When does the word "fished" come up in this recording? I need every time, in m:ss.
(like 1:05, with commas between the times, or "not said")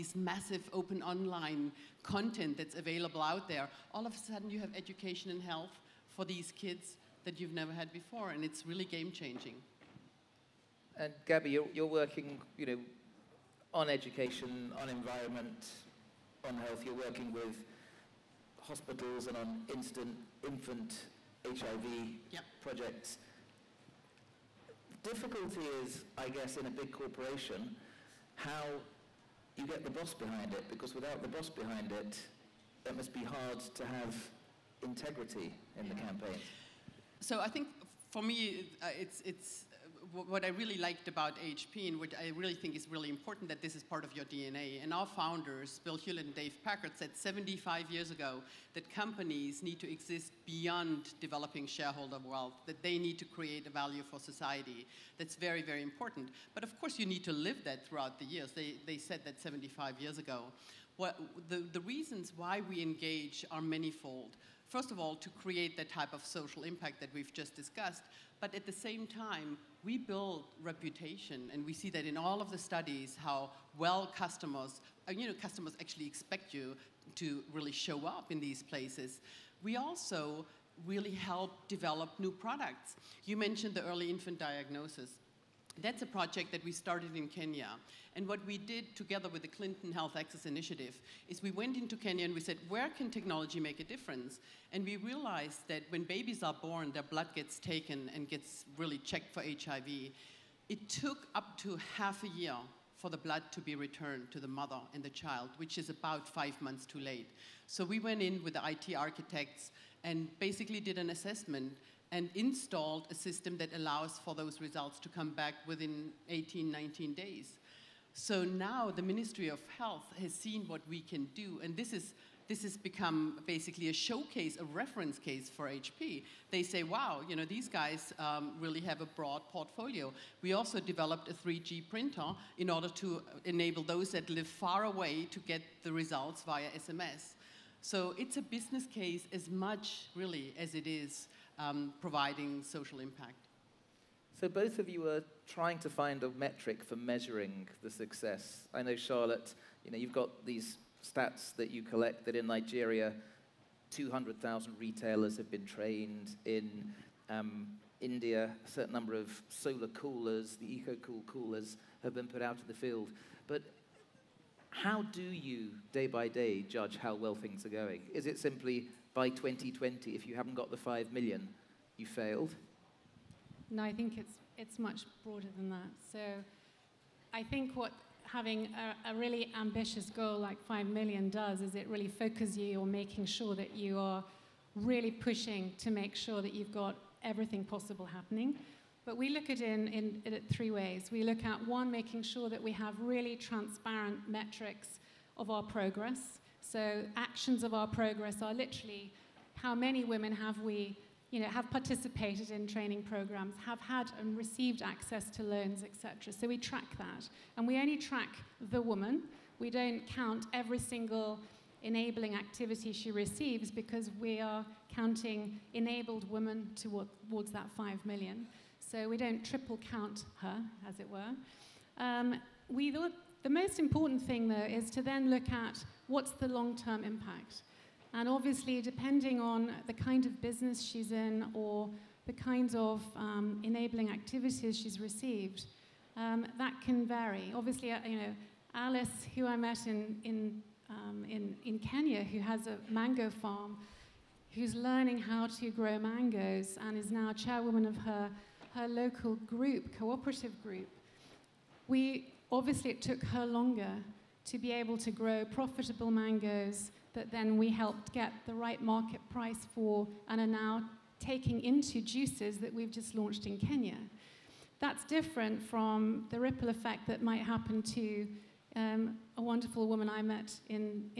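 not said.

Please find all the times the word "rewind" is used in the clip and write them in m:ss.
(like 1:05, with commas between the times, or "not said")
not said.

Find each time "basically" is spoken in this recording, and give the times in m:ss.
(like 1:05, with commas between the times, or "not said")
1:50, 2:03.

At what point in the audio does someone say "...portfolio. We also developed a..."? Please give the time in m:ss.
2:09.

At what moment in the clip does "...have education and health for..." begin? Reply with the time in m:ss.
0:04.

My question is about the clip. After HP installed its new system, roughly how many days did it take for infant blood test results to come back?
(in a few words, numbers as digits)
18 to 19 days.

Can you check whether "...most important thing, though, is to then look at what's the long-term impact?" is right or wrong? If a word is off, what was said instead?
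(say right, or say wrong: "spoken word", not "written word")
right.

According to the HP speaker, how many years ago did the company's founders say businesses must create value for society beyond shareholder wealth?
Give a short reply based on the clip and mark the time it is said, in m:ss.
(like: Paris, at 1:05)
75, at 0:47.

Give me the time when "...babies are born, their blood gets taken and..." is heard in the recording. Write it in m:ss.
1:36.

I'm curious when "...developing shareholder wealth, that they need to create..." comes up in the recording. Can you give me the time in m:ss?
0:51.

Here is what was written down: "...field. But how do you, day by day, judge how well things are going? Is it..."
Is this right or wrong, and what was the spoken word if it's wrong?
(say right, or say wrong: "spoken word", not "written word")
right.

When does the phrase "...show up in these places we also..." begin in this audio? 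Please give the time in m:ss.
1:17.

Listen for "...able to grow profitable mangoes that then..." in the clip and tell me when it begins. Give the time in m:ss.
4:14.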